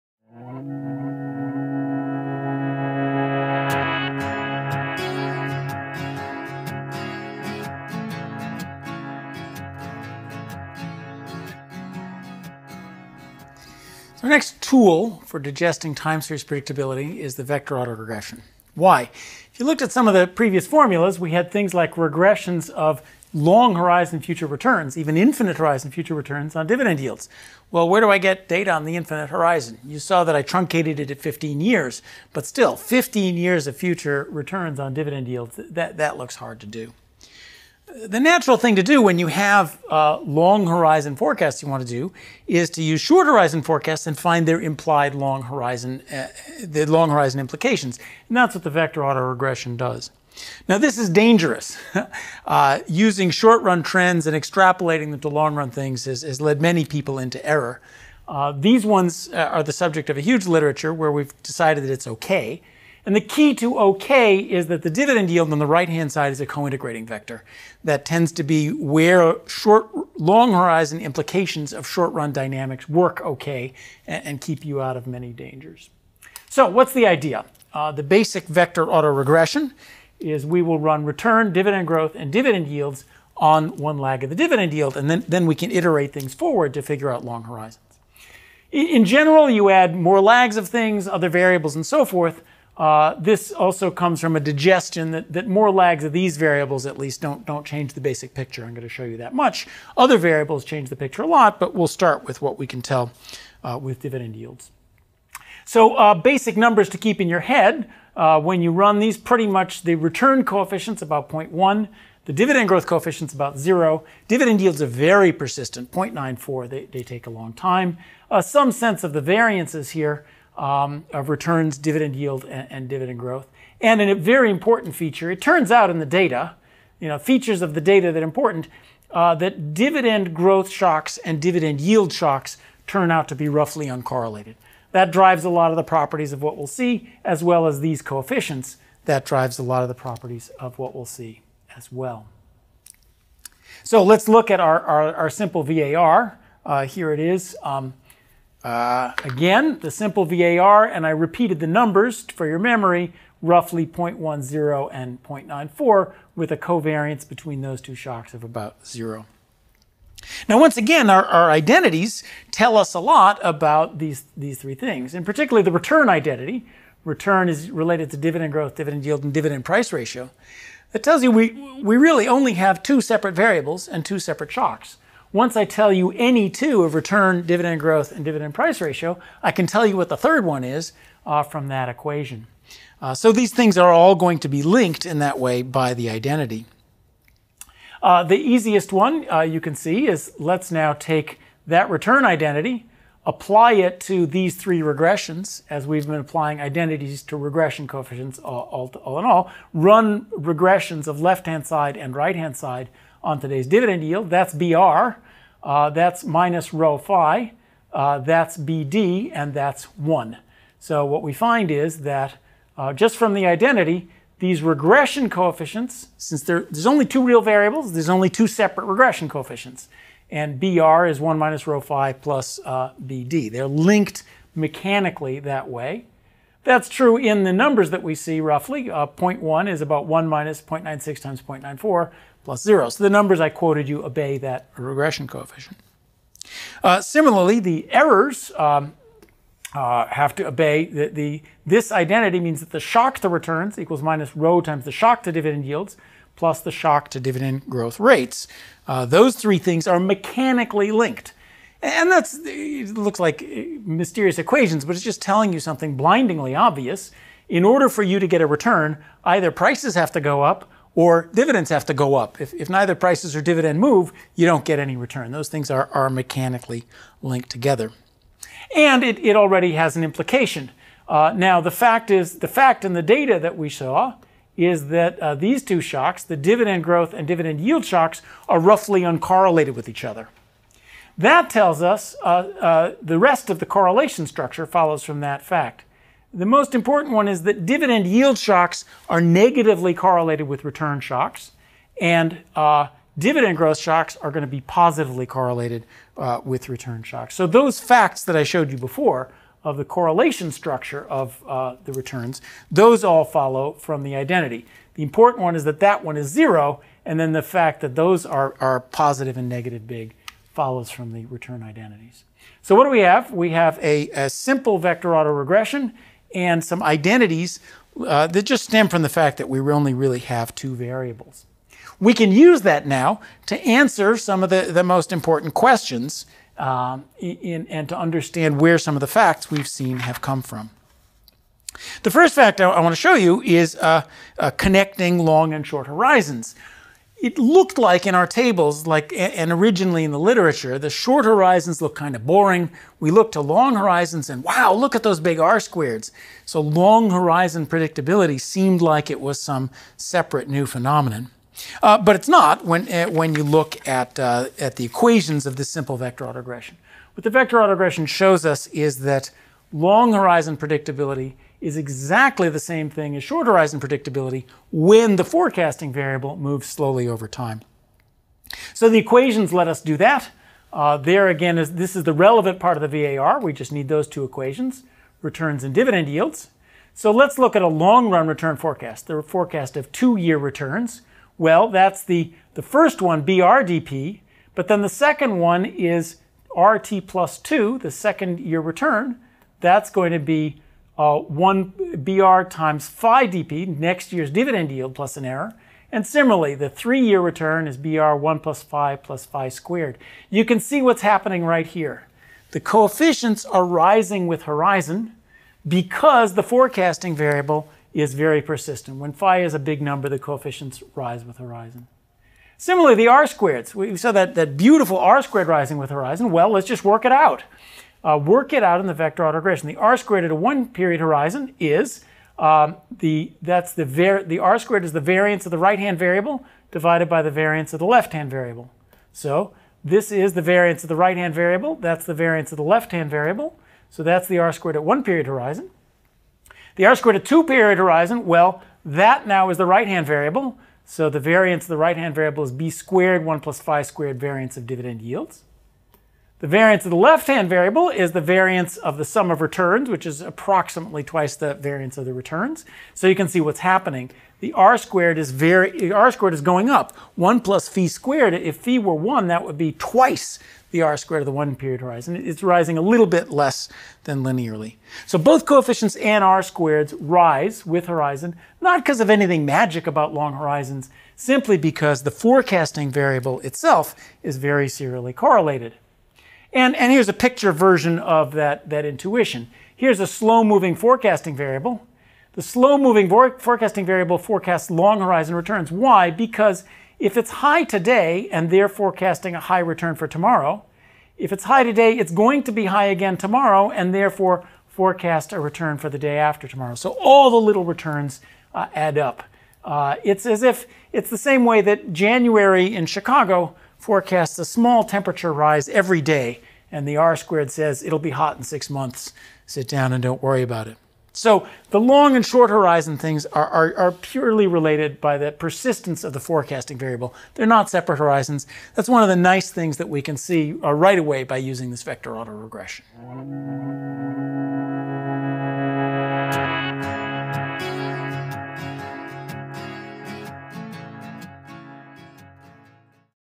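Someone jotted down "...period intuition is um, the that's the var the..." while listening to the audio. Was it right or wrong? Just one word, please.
wrong.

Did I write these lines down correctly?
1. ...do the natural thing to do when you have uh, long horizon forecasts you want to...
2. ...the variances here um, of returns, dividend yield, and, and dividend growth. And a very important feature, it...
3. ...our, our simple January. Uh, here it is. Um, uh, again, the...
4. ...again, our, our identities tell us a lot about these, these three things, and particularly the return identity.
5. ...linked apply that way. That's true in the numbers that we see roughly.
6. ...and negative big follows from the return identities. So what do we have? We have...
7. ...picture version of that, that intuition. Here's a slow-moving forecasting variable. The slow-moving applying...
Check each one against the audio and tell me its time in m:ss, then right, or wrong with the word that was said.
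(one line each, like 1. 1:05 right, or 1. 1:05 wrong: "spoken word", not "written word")
1. 0:36 right
2. 1:59 right
3. 2:24 wrong: "VAR", not "January"
4. 2:40 right
5. 3:43 wrong: "mechanically", not "apply"
6. 5:09 right
7. 7:57 wrong: "forecasting", not "applying".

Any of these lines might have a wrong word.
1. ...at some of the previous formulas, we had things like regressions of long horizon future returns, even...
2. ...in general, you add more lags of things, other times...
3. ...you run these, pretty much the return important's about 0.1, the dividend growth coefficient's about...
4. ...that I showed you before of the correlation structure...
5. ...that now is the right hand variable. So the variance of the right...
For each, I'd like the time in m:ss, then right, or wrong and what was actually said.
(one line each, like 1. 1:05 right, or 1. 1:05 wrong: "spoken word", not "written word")
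1. 0:19 right
2. 1:28 wrong: "variables", not "times"
3. 1:48 wrong: "coefficient", not "important"
4. 4:58 right
5. 7:18 right.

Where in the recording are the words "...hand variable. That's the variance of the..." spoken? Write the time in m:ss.
7:11.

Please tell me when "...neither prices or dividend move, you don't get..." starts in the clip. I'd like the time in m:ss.
4:22.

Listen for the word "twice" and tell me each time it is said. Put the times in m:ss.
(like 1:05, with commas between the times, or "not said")
7:31, 7:39.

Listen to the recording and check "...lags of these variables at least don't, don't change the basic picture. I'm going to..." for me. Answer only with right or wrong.
right.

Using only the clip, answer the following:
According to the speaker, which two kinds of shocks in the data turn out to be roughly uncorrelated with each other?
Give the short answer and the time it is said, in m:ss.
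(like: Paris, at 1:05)
dividend growth and dividend yield shocks, at 2:09.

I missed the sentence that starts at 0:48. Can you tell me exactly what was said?
And that's what the vector autoregression does.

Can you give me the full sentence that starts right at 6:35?
And similarly, the three-year return is BR 1 plus phi plus phi squared.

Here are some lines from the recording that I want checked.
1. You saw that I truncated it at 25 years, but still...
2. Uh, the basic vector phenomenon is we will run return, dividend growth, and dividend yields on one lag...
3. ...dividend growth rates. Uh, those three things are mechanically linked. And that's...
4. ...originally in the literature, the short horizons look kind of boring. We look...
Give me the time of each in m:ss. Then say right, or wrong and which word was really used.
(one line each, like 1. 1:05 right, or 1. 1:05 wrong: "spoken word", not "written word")
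1. 0:29 wrong: "15", not "25"
2. 1:17 wrong: "autoregression", not "phenomenon"
3. 4:07 right
4. 5:39 right.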